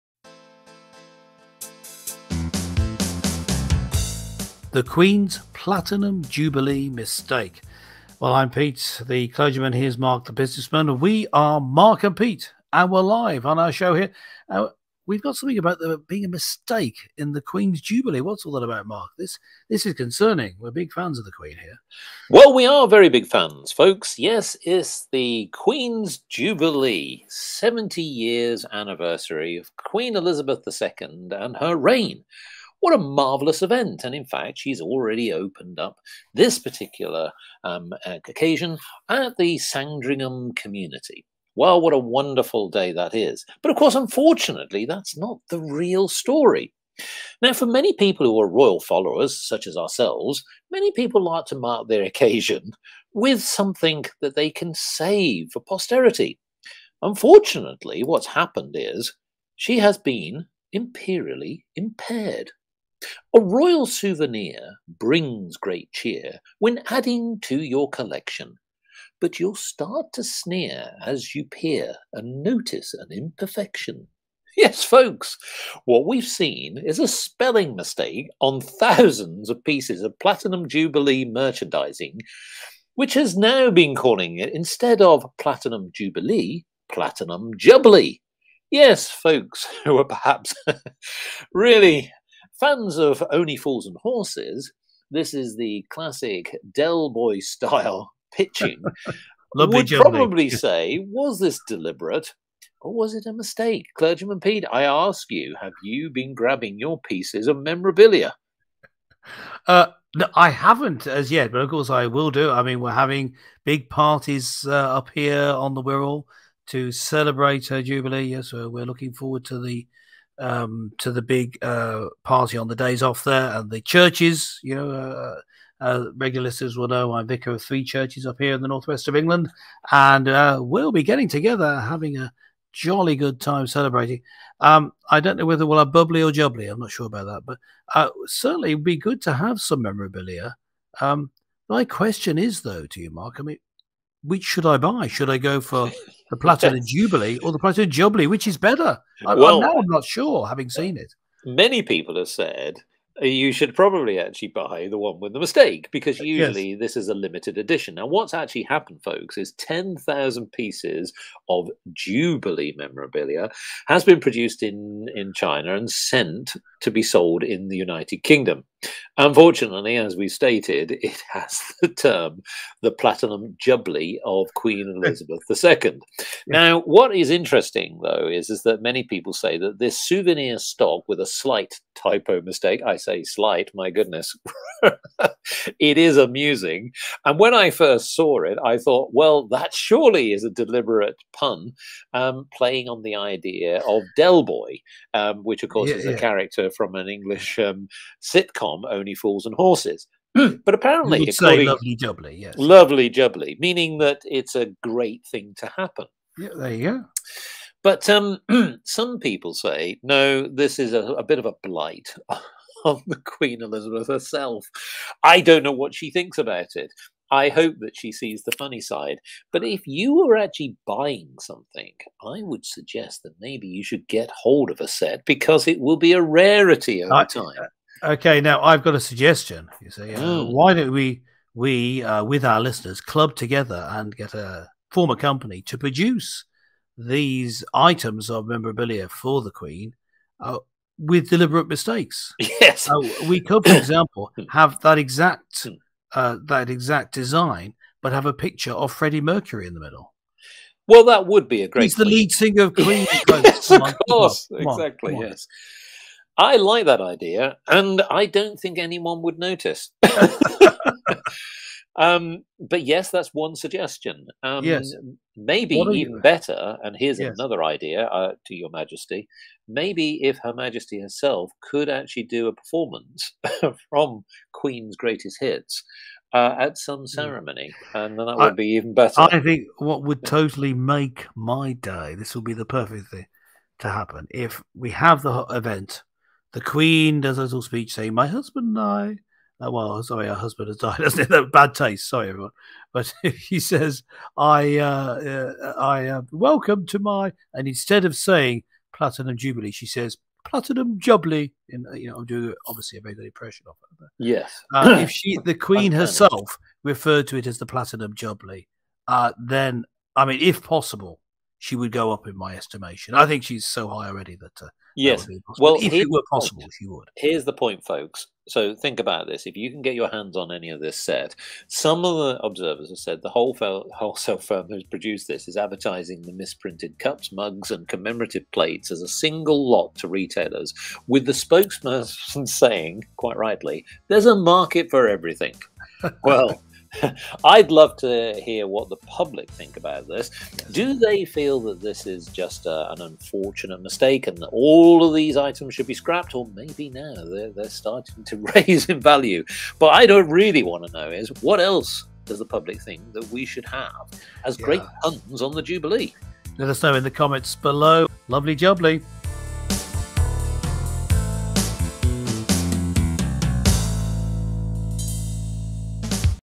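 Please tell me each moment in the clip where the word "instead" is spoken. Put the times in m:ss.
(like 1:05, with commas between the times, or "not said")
1:24, 4:57.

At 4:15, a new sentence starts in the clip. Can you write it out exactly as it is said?
Yes, I like that idea, and I don't think anyone would notice.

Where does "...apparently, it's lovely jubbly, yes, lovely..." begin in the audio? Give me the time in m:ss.
3:20.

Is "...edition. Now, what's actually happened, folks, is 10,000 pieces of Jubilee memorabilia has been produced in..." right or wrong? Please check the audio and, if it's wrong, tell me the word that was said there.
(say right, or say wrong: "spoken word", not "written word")
right.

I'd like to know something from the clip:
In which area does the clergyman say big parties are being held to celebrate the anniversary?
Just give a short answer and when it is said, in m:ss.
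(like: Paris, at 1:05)
the Wirral, at 1:55.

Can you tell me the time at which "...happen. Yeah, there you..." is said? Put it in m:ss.
3:25.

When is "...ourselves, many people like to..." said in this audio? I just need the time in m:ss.
0:49.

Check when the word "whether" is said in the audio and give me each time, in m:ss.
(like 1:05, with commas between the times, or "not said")
2:15.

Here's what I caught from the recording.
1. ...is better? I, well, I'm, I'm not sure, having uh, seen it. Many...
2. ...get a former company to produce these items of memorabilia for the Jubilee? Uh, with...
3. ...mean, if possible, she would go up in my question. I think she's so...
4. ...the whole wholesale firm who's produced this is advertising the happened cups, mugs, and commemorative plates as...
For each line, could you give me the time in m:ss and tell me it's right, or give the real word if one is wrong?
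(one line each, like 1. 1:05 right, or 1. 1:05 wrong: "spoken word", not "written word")
1. 2:28 right
2. 3:54 wrong: "Queen", not "Jubilee"
3. 5:10 wrong: "estimation", not "question"
4. 5:23 wrong: "misprinted", not "happened".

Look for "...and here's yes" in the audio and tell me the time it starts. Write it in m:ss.
4:26.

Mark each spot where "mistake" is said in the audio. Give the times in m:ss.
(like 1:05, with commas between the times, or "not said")
0:06, 0:16, 1:17, 1:43, 2:35, 3:02, 4:01, 5:43.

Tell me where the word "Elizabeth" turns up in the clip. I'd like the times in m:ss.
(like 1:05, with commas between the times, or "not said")
0:30, 2:55, 3:33.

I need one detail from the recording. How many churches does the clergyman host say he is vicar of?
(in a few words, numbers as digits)
3.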